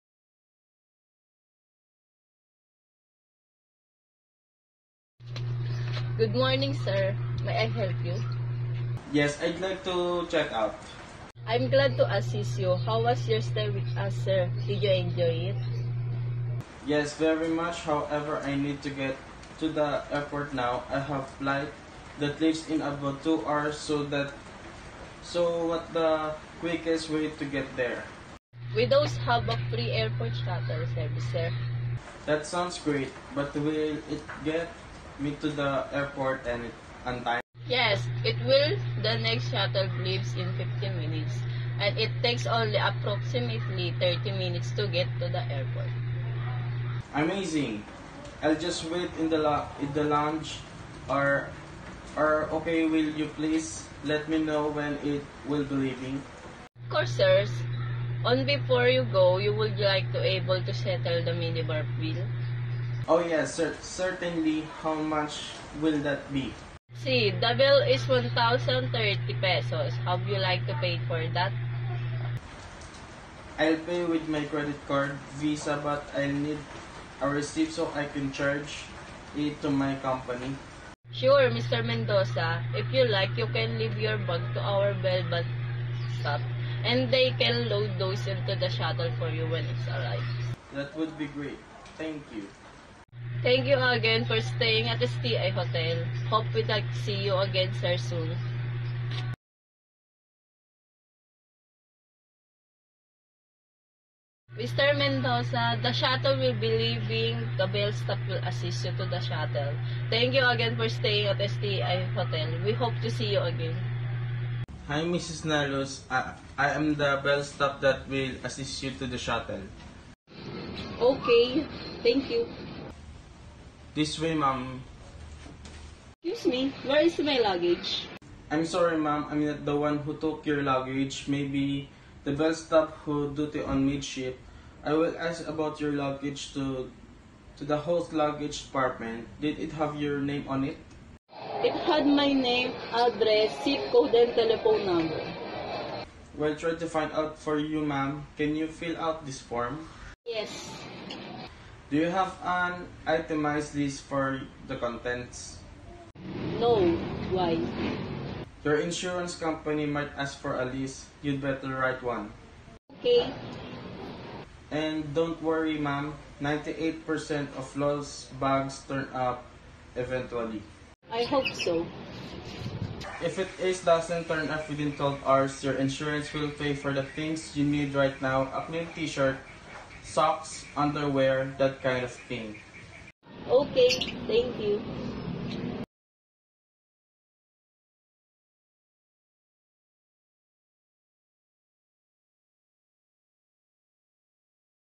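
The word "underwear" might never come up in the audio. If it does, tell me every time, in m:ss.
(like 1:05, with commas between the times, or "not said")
3:00.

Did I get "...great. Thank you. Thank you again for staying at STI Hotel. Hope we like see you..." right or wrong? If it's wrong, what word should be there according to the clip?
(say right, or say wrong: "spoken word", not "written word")
right.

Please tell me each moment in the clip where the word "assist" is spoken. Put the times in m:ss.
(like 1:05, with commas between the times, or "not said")
0:12, 1:48, 1:58.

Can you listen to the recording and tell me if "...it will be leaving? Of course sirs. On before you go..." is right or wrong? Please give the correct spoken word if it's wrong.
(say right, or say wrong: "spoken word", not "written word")
right.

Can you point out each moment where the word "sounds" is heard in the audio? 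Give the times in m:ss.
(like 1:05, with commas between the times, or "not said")
0:32.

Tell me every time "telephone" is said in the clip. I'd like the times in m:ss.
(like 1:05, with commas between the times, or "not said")
2:24.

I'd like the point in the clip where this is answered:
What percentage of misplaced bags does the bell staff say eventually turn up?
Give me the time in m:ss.
2:46.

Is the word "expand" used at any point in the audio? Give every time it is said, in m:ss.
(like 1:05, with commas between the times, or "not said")
not said.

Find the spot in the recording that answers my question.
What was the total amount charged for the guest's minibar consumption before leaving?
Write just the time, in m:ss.
1:08.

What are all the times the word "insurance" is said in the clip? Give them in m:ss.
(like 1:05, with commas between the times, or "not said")
2:38, 2:55.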